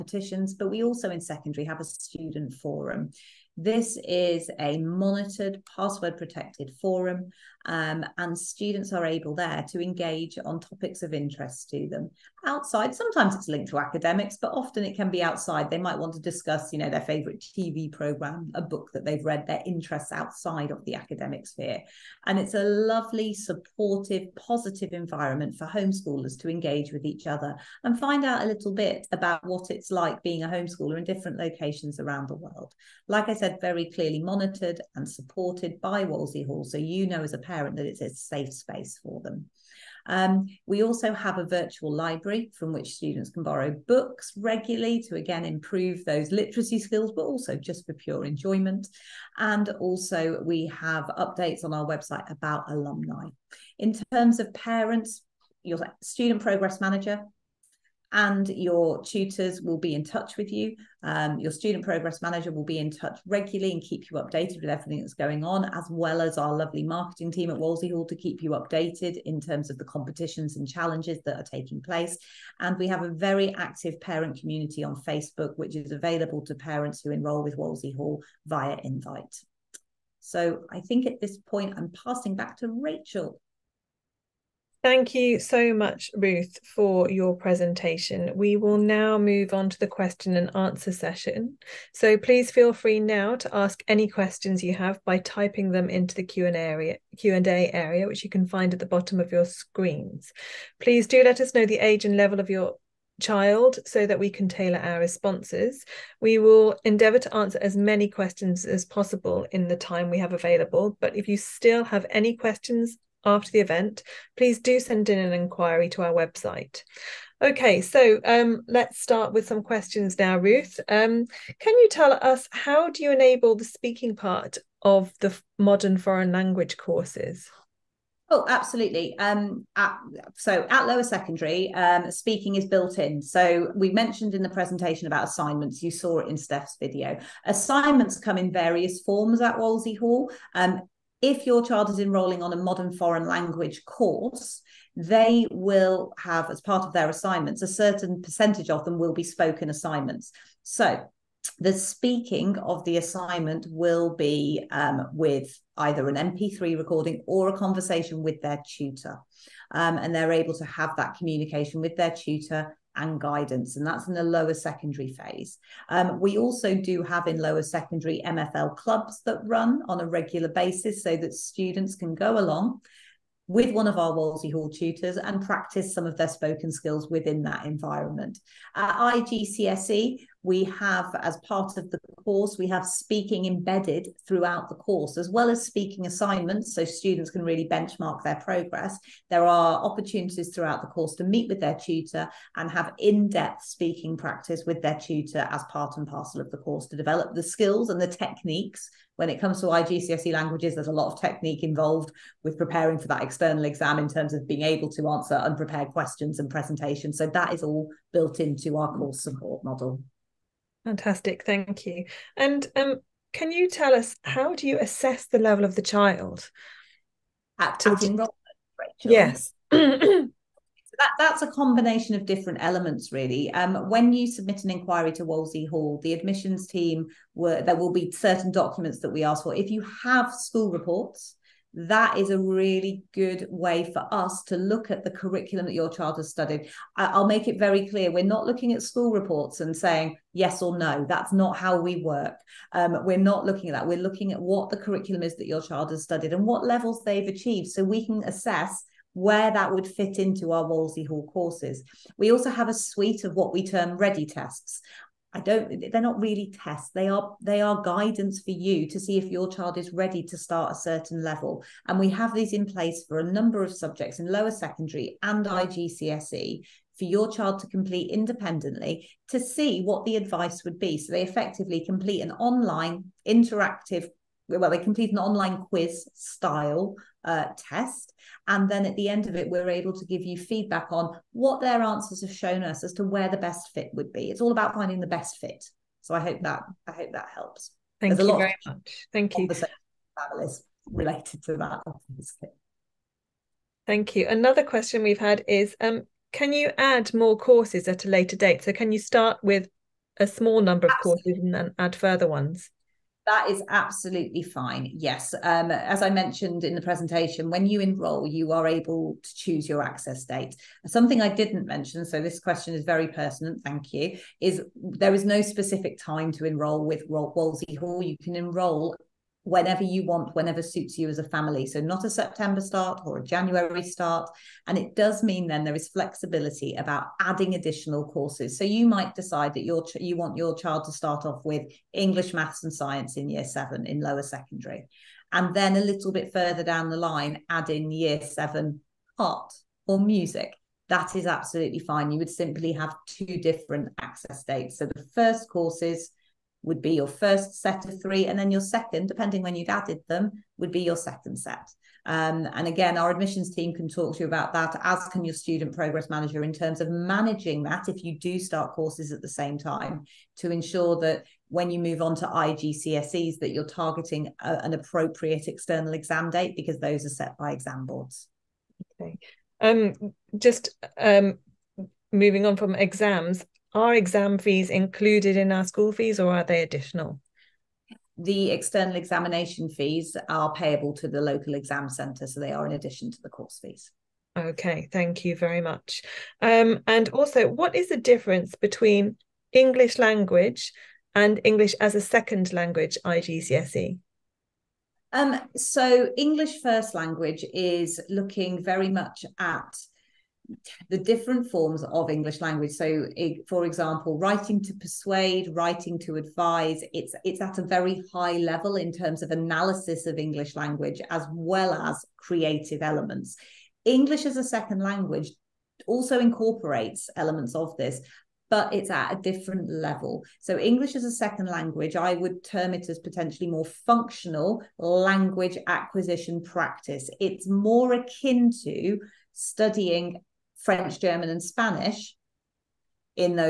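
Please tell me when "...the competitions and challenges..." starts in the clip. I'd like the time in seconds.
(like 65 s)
69 s.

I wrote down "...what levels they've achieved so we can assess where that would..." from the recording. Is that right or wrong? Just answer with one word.
right.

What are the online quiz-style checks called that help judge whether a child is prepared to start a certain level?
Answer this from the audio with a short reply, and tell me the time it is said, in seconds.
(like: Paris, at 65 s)
Ready tests, at 253 s.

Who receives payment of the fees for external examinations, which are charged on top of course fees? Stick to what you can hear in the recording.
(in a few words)
Local exam centre.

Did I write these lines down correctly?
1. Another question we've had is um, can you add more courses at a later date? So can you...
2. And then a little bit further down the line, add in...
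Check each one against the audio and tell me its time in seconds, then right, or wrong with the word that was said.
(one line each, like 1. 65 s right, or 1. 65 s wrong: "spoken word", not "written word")
1. 294 s right
2. 335 s right.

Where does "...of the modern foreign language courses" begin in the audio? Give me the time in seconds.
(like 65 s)
124 s.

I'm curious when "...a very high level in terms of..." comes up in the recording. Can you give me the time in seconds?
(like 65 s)
407 s.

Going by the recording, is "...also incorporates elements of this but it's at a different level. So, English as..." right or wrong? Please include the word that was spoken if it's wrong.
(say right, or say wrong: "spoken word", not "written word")
right.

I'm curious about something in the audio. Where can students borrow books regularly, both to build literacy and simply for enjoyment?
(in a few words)
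Virtual library.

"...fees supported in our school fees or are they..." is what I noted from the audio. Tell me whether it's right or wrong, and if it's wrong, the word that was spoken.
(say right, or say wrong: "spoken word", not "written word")
wrong: "included", not "supported".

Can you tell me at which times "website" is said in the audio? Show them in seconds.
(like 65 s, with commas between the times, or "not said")
51 s, 116 s.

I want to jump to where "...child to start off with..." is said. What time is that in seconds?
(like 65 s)
330 s.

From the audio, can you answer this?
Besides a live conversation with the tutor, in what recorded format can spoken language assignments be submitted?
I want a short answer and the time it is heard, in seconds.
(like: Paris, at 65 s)
MP3 recording, at 156 s.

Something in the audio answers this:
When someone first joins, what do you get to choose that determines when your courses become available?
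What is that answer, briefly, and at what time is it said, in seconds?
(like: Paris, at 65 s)
Access date, at 309 s.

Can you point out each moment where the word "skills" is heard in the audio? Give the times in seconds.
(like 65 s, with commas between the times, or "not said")
46 s, 176 s, 197 s.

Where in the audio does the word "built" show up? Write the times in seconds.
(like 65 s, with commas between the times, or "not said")
132 s, 208 s.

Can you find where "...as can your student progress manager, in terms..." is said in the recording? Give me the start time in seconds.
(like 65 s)
354 s.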